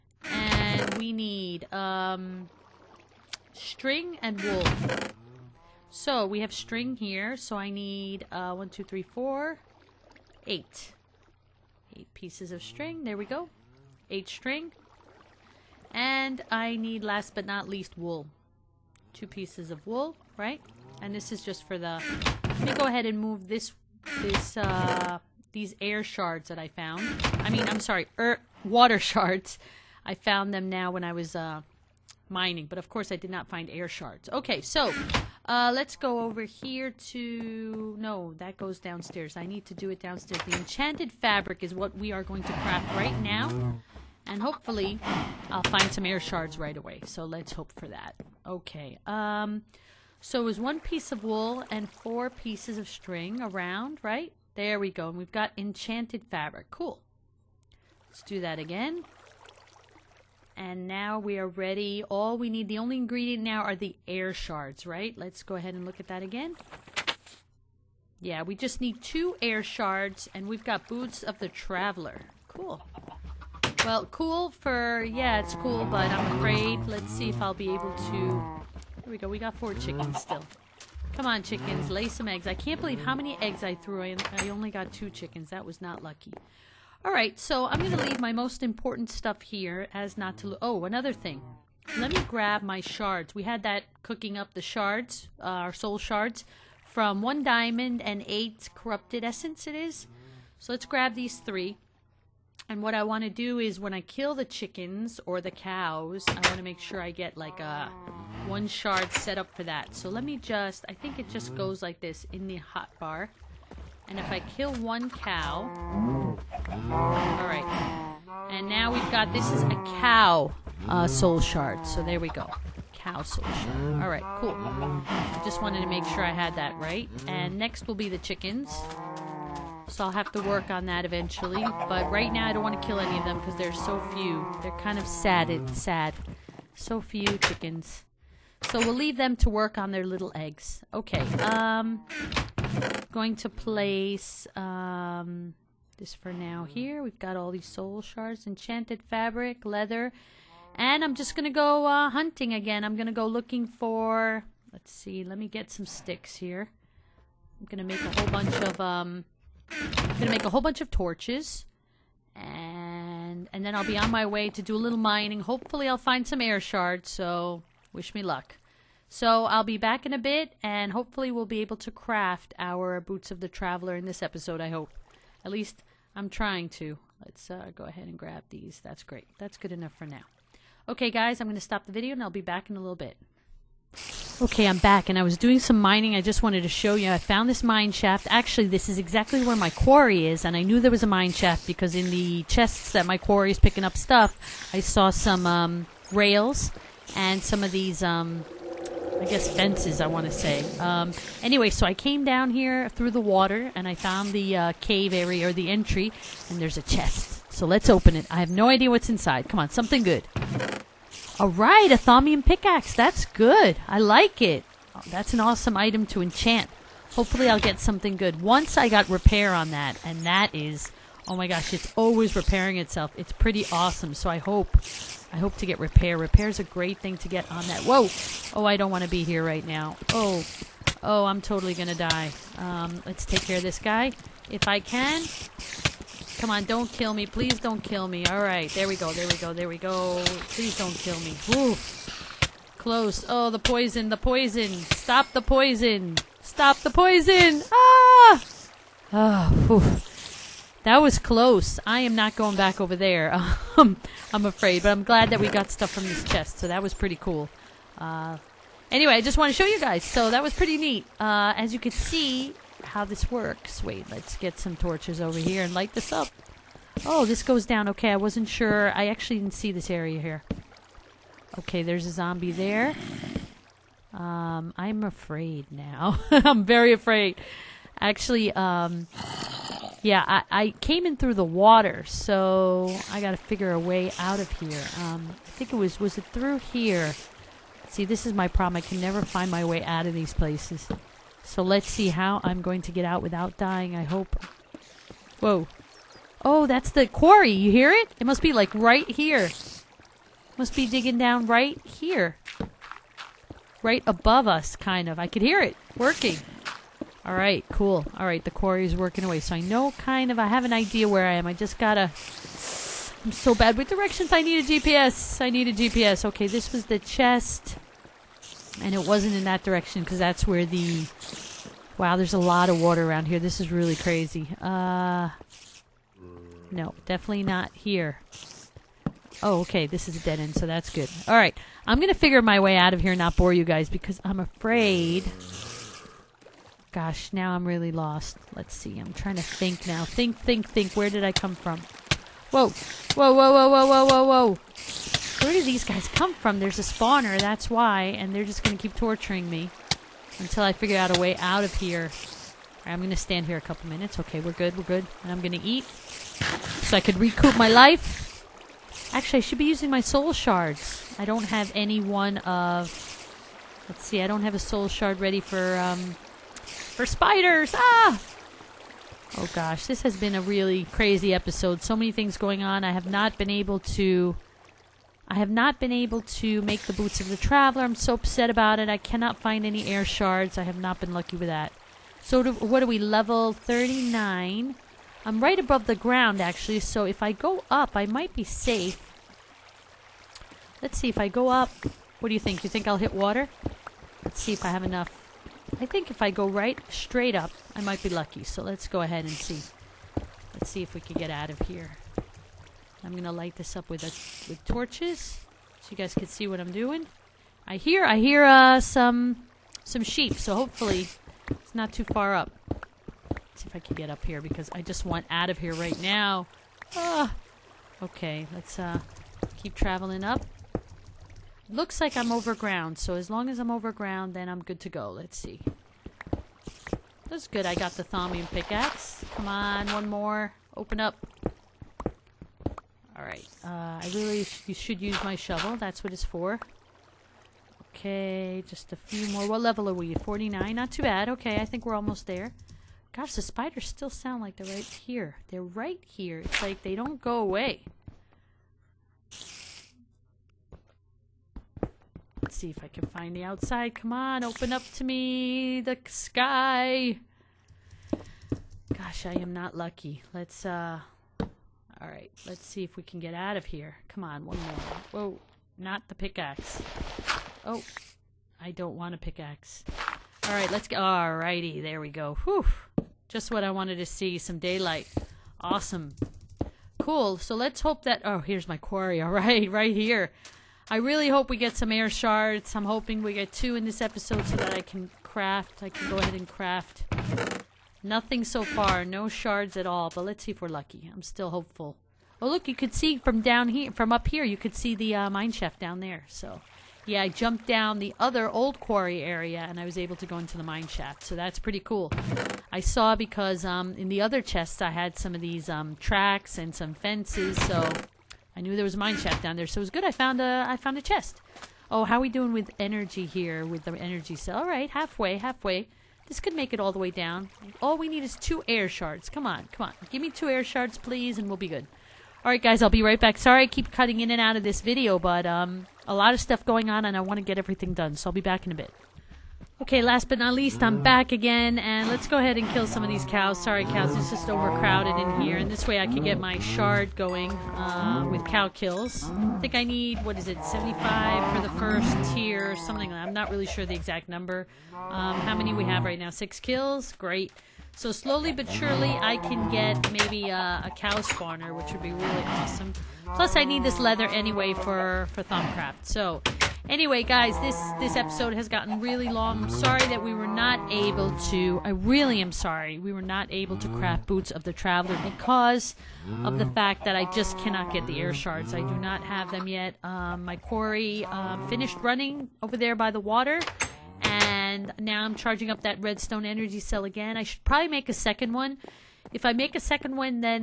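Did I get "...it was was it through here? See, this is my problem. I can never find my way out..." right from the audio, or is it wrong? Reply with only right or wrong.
right.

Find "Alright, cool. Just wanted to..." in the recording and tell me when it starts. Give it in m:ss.
2:03.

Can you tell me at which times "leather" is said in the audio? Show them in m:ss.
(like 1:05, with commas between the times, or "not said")
2:29, 9:13.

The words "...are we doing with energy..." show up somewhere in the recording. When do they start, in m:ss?
8:32.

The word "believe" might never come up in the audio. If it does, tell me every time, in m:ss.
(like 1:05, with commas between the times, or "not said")
1:22.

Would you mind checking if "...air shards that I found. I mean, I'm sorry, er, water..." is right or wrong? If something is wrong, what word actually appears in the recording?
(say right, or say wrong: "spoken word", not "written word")
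right.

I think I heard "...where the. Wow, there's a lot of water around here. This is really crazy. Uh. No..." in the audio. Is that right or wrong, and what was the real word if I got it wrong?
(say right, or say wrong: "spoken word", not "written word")
right.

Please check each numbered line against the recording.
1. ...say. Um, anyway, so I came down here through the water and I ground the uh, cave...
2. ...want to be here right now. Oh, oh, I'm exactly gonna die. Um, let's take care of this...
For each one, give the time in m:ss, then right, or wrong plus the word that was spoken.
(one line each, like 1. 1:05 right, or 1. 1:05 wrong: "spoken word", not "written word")
1. 3:20 wrong: "found", not "ground"
2. 3:48 wrong: "totally", not "exactly".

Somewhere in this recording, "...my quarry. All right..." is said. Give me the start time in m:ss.
7:58.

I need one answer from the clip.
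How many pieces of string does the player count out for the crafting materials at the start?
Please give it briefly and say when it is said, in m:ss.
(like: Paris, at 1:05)
8, at 0:14.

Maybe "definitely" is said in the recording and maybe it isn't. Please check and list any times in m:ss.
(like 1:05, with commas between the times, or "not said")
5:27.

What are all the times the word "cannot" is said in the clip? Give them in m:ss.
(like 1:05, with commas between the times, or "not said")
6:18, 9:27.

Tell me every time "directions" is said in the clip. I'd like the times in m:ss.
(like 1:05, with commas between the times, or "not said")
5:13, 5:19.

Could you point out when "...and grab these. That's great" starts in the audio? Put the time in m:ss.
2:58.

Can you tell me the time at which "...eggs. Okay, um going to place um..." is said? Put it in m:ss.
2:20.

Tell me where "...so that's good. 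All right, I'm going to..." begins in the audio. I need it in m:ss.
5:30.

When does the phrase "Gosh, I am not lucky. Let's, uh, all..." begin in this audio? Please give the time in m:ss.
7:38.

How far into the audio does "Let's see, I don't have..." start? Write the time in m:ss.
6:03.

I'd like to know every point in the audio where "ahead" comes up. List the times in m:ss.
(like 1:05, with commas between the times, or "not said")
0:22, 1:05, 2:57, 6:39, 8:06, 8:52.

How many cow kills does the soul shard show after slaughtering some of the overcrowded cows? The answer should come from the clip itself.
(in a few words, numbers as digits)
6.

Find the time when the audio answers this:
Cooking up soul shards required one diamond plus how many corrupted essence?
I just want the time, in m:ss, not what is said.
1:38.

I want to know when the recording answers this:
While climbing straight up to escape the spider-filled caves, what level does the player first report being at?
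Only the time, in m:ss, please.
6:22.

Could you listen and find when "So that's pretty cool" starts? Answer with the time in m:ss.
8:21.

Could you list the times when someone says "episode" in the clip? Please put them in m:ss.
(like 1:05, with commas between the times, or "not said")
2:54, 6:11, 8:04, 9:18.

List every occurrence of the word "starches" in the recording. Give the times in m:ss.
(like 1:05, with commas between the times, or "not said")
not said.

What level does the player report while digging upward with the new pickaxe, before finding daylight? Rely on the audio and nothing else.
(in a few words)
49.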